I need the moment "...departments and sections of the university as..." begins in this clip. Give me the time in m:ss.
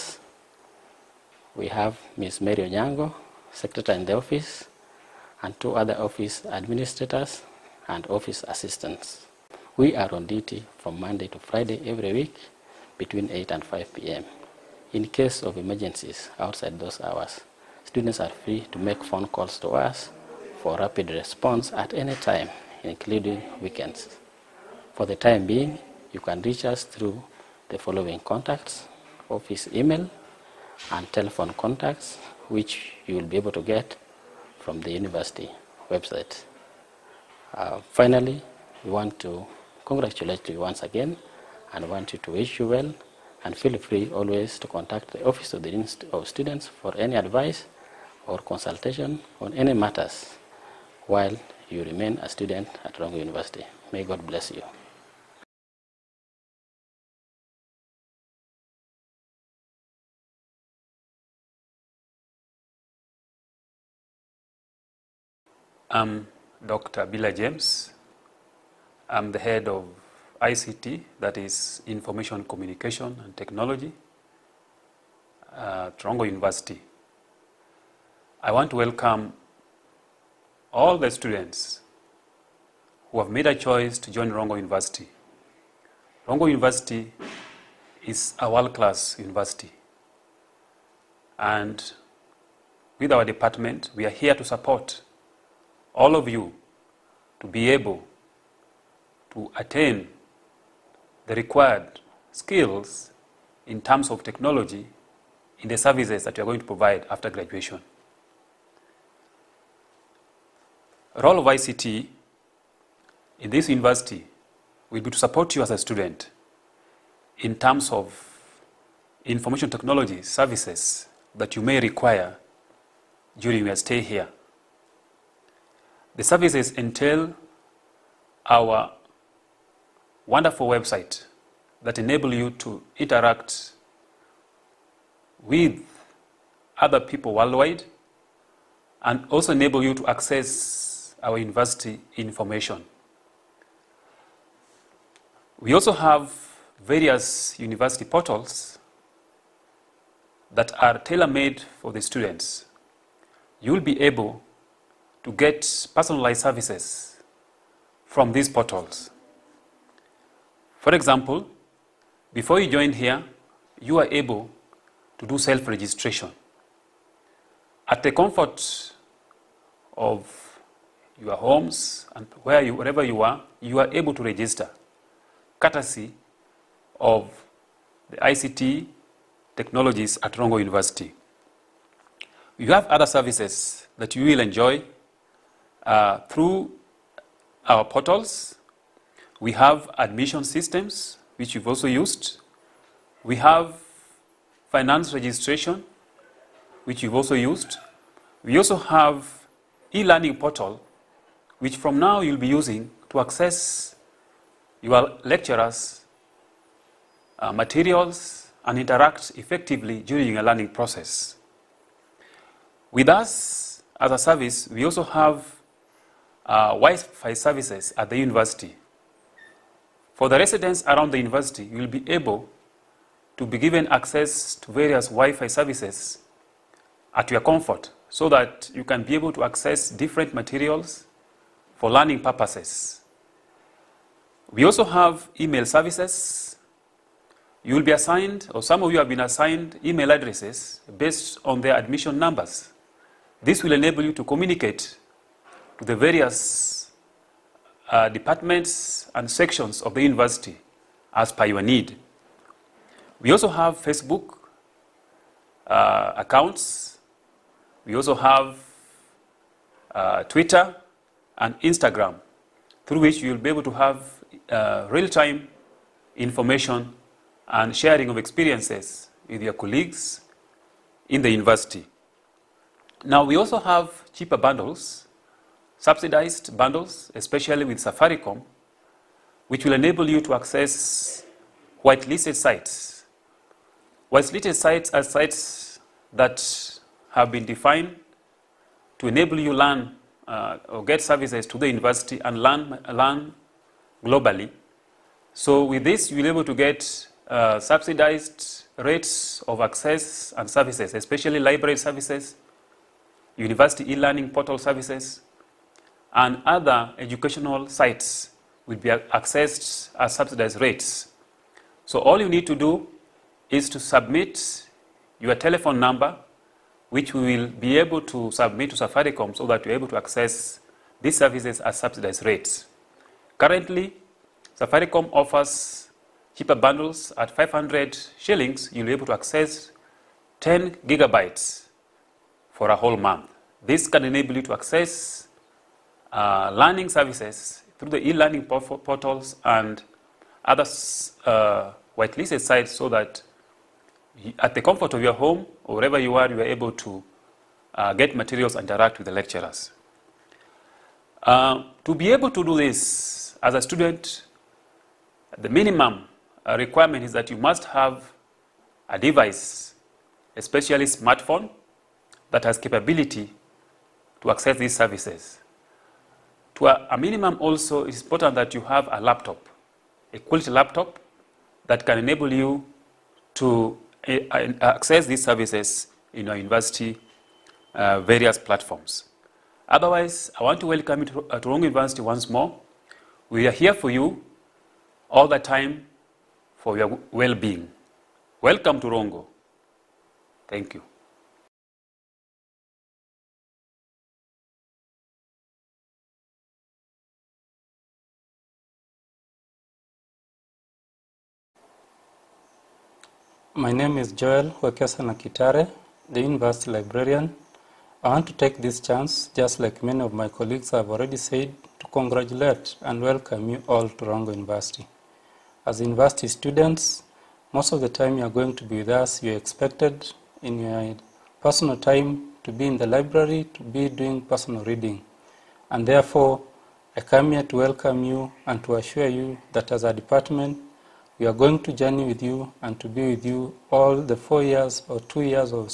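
4:08.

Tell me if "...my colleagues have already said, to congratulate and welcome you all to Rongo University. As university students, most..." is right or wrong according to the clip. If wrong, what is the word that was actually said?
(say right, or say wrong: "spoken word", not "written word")
right.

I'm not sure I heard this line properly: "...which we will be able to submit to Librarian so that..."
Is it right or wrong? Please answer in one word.
wrong.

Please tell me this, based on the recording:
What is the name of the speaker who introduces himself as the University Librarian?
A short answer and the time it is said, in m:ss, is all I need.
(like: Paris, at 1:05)
Joel Wekesana Kitare, at 6:44.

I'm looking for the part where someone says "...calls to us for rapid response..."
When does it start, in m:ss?
0:19.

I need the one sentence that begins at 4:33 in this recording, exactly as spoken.
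Now, we also have cheaper bundles subsidized bundles, especially with Safaricom, which will enable you to access whitelisted sites.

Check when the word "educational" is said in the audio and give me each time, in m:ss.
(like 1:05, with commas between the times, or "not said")
5:06.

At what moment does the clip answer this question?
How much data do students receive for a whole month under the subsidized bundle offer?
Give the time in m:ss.
5:30.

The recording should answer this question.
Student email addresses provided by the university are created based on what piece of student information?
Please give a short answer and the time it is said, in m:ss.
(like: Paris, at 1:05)
admission numbers, at 4:01.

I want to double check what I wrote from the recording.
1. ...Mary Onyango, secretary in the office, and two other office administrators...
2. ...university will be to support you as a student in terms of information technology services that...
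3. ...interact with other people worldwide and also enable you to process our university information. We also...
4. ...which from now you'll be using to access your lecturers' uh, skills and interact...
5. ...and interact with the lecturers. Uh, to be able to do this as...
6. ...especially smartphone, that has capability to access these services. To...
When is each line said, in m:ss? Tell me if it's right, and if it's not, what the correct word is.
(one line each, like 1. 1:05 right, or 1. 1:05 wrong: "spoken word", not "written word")
1. 0:02 right
2. 1:53 right
3. 2:12 wrong: "access", not "process"
4. 3:21 wrong: "materials", not "skills"
5. 5:48 right
6. 6:00 right.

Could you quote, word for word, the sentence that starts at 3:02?
You have other services that you will enjoy uh, through our portals.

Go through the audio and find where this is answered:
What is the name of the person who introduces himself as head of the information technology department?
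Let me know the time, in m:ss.
1:07.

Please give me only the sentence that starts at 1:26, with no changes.
Rongo University is a world-class university.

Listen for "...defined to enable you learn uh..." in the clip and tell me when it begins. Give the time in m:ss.
4:47.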